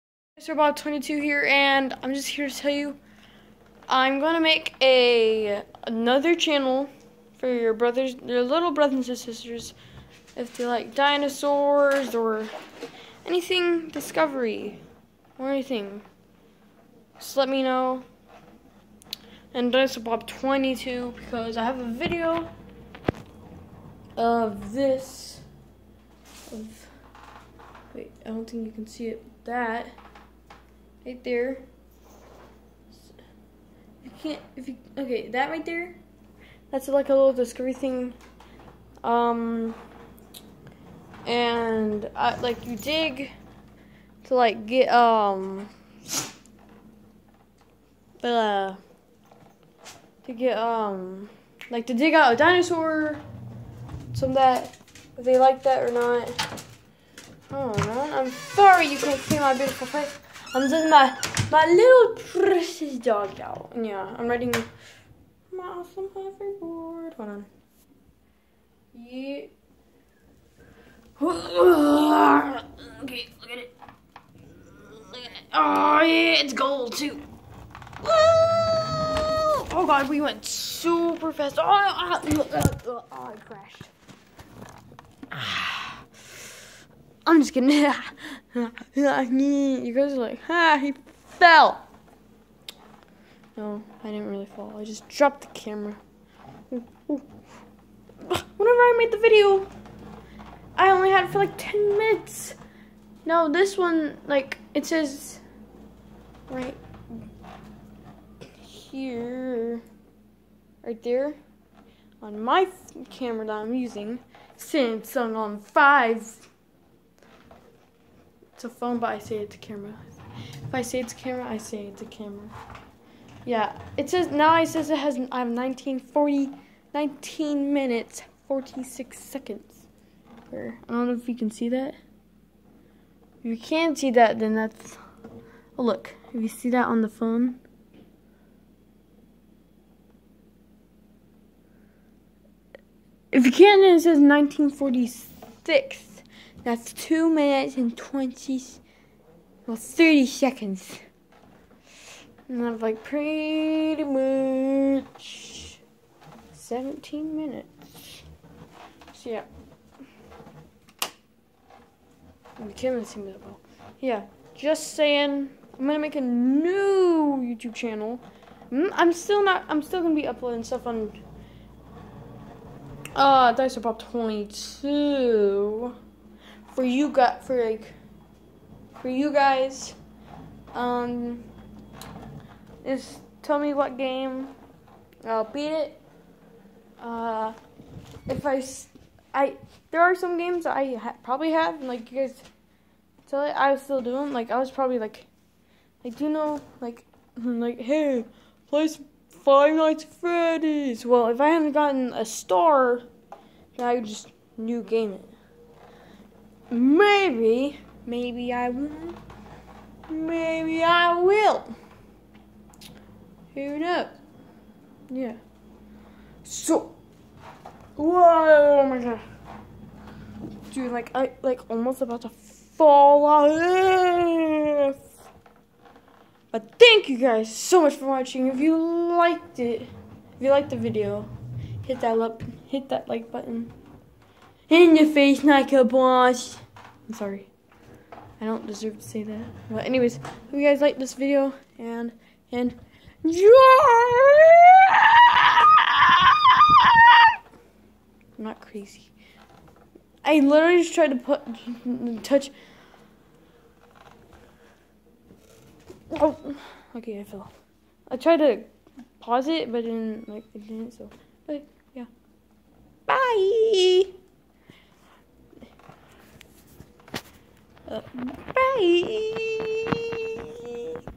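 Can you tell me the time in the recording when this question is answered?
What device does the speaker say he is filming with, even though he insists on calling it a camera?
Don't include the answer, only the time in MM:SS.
01:54.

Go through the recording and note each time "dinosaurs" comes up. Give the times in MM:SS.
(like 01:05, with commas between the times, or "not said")
00:10, 00:19, 00:52.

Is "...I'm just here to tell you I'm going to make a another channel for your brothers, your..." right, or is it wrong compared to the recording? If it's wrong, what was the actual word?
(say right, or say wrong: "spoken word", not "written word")
right.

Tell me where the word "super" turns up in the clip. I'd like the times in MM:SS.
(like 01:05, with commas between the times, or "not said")
01:20.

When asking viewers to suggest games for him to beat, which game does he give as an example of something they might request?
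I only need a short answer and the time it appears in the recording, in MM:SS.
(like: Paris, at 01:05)
Five Nights at Freddy's, at 03:19.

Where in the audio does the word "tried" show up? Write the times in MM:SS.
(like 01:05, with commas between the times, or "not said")
04:10, 04:18.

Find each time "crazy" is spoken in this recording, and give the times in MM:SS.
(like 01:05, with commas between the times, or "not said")
04:08.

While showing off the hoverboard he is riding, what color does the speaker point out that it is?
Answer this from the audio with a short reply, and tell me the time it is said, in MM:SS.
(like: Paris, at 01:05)
Gold, at 01:16.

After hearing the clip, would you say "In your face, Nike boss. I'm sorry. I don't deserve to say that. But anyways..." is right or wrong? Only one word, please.
right.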